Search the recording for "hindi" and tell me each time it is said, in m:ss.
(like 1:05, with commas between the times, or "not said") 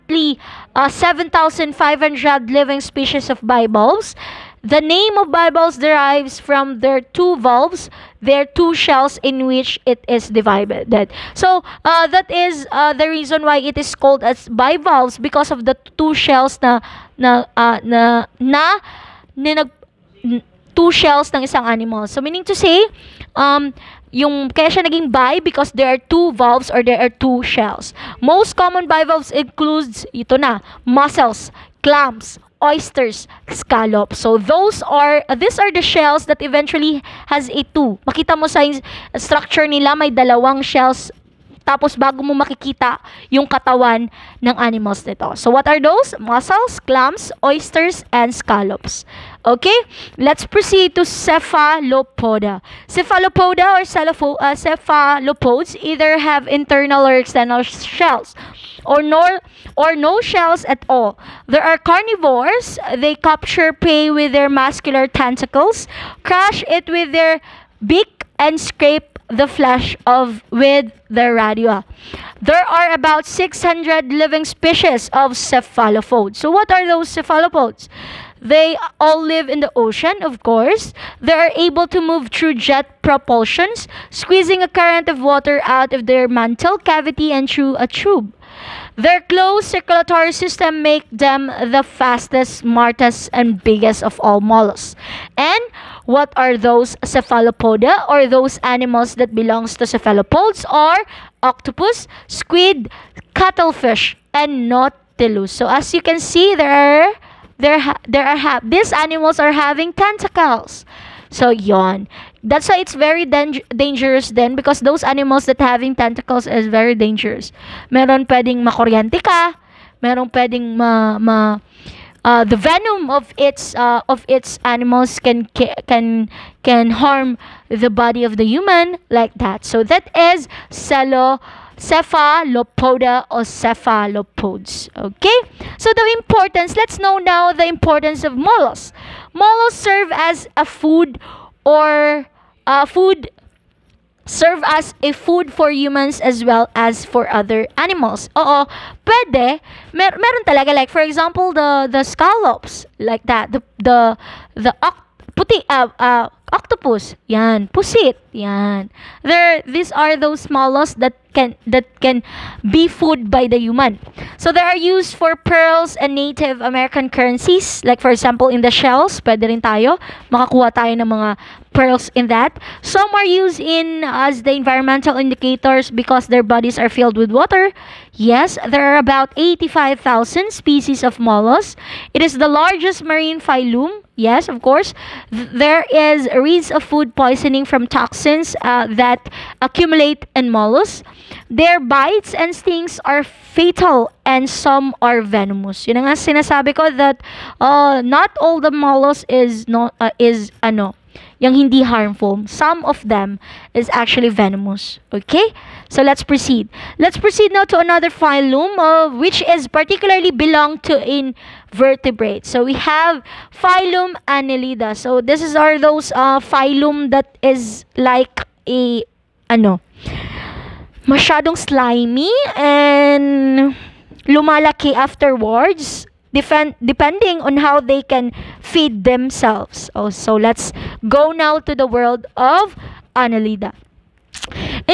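3:21.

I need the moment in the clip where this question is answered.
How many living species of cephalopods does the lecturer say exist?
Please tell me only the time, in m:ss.
1:13.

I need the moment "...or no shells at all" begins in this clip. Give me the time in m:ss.
0:59.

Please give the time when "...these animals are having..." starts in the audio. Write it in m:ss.
1:48.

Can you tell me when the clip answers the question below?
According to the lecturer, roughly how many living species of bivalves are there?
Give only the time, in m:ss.
0:00.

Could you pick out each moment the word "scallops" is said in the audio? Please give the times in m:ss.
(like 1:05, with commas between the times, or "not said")
0:33, 0:48, 2:32.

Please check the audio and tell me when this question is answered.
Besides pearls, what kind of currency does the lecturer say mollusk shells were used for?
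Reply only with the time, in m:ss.
2:46.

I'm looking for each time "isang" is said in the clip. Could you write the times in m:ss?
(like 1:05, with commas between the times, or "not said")
0:21.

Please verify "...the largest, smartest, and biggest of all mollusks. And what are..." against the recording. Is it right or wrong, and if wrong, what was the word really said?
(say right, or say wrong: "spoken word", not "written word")
wrong: "fastest", not "largest".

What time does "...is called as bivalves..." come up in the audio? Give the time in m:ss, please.
0:13.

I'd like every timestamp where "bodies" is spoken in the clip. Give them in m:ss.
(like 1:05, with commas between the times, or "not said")
2:56.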